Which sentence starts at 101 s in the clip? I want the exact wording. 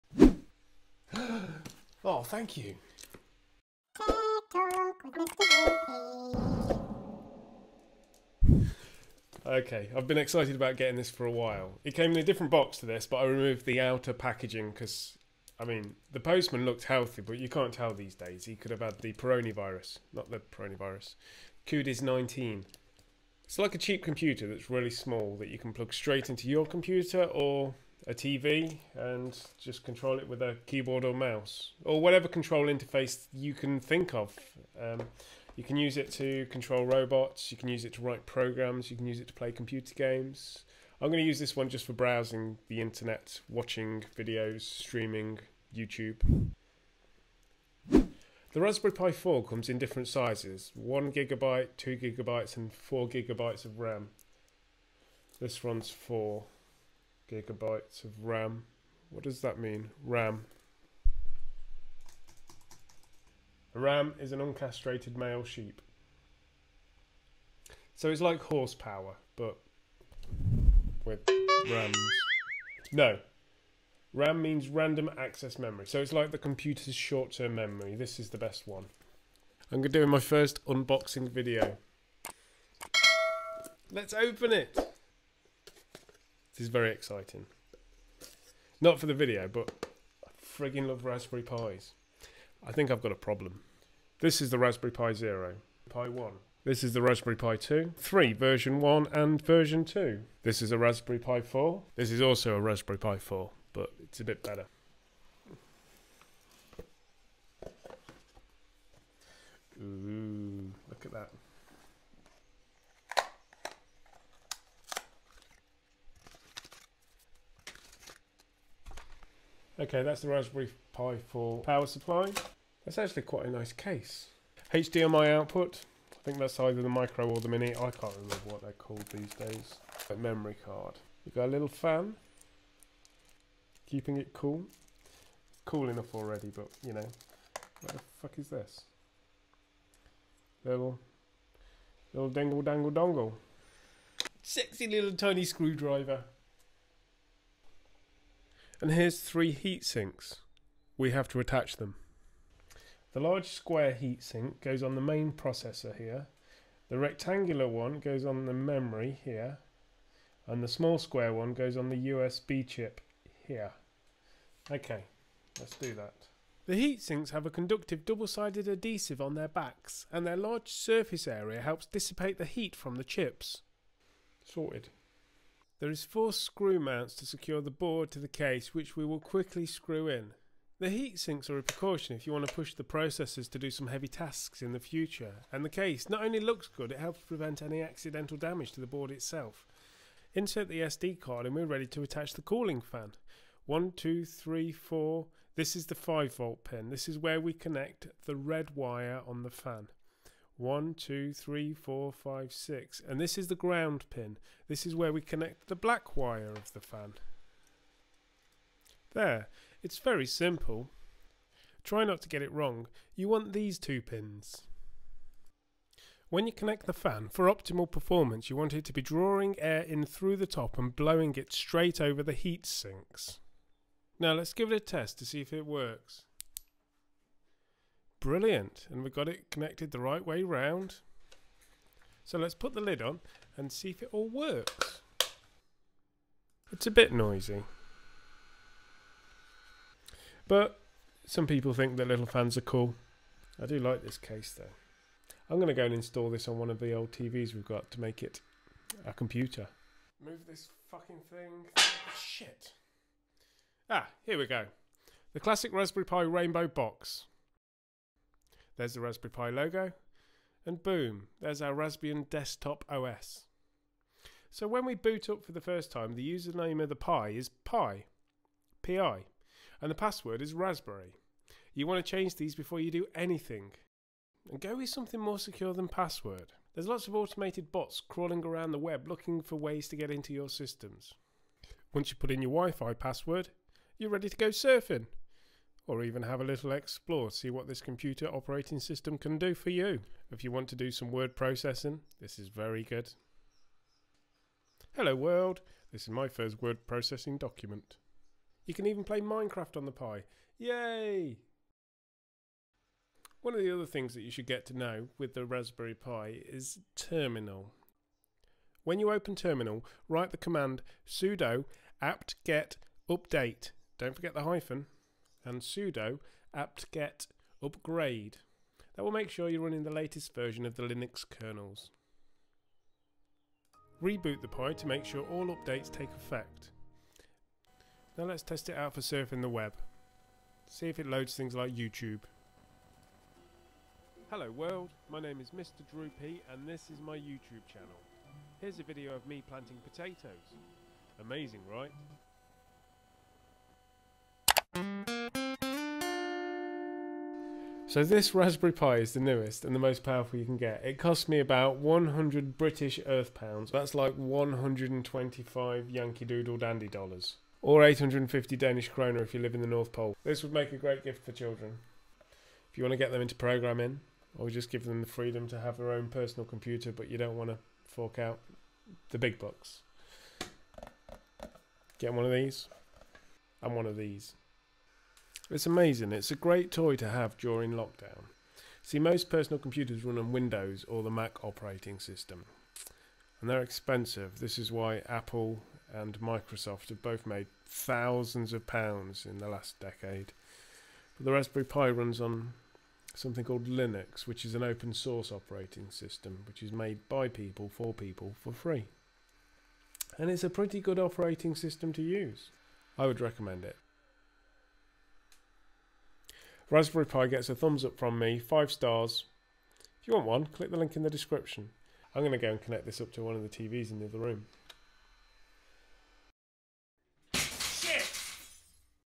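This is also a Raspberry Pi 4 but it's a bit better.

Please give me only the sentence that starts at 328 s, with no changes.
Now let's test it out for surfing the web.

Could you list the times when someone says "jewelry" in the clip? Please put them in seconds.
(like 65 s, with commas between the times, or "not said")
not said.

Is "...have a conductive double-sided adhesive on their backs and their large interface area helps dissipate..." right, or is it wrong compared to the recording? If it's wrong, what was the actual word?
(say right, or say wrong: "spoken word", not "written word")
wrong: "surface", not "interface".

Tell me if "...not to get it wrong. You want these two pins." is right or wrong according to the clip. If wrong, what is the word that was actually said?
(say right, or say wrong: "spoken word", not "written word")
right.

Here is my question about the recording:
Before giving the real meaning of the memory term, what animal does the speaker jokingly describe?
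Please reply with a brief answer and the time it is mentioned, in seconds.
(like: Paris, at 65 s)
uncastrated male sheep, at 64 s.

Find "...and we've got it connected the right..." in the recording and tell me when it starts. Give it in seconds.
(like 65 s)
228 s.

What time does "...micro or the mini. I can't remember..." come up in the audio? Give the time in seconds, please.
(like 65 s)
126 s.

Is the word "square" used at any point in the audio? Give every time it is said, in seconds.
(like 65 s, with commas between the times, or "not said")
153 s, 160 s.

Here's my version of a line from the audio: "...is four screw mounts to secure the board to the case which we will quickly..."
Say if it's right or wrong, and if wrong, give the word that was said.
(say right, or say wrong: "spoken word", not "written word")
right.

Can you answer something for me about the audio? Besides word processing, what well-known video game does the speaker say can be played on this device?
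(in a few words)
Minecraft.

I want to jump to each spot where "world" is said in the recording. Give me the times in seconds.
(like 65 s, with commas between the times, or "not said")
295 s, 334 s.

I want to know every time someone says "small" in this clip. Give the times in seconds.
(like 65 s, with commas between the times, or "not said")
24 s, 160 s.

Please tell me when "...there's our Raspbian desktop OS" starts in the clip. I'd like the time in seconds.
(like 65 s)
261 s.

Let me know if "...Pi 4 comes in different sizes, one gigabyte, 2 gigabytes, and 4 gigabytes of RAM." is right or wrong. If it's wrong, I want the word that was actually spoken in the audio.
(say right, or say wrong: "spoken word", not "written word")
right.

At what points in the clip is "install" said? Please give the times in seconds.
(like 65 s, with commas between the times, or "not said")
245 s.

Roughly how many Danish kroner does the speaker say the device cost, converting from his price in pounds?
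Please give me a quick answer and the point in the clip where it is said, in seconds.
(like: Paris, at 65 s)
850, at 357 s.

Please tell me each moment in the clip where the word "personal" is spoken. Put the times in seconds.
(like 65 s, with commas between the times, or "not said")
366 s, 379 s.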